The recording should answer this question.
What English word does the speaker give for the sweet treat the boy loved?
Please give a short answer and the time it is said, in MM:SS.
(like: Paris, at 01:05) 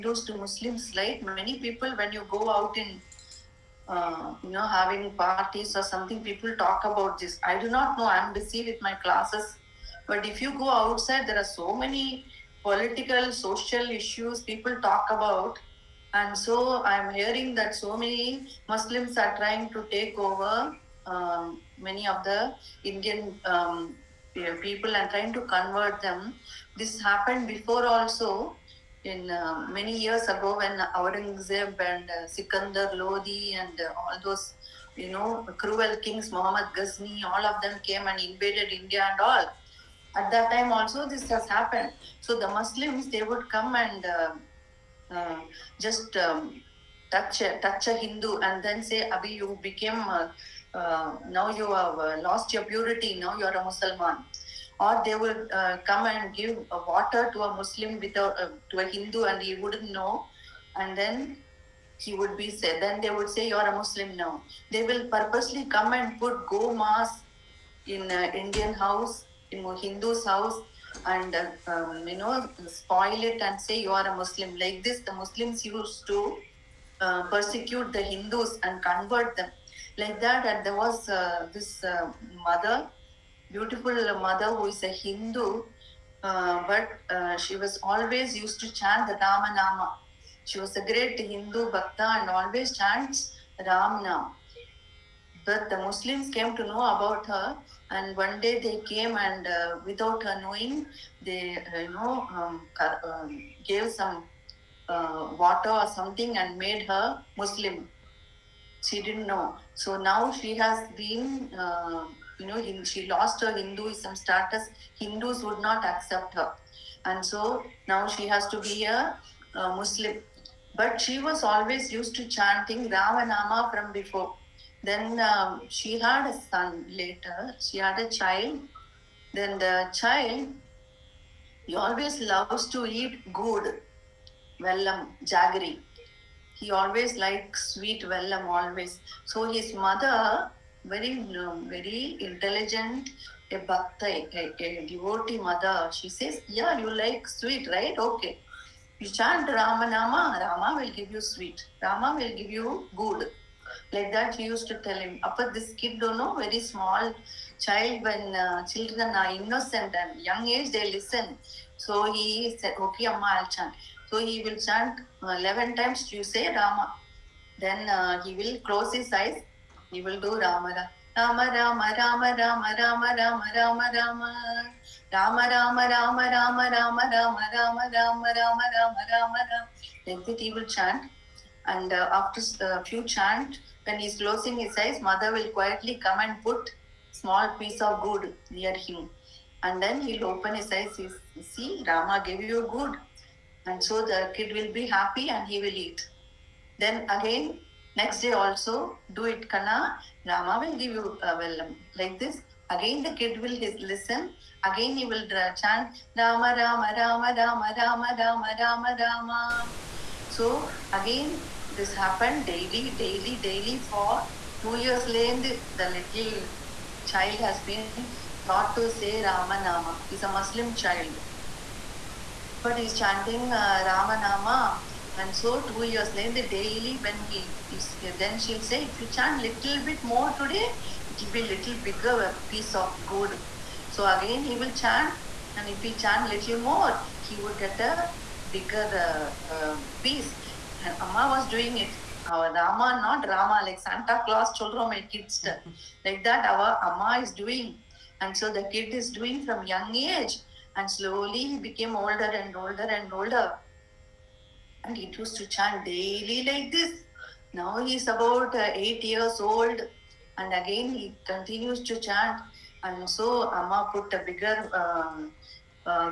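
jaggery, at 02:15.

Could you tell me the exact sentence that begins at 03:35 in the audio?
Late, the little child has been taught to say Rama Nama.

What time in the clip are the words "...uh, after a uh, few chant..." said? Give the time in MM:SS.
03:01.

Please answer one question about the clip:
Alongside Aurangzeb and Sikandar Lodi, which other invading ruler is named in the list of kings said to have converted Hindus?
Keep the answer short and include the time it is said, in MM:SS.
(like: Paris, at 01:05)
Muhammad Ghazni, at 00:36.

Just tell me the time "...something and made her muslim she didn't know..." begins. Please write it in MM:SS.
01:45.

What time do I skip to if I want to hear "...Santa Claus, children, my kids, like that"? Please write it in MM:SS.
04:03.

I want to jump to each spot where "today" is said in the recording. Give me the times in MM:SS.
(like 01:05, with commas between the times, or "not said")
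03:50.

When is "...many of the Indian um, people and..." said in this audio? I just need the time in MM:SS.
00:21.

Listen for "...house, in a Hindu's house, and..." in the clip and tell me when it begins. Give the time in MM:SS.
01:08.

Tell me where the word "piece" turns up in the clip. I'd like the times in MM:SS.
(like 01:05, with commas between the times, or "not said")
03:07, 03:52, 04:00.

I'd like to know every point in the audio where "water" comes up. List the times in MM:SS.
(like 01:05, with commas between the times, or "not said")
00:56, 01:45.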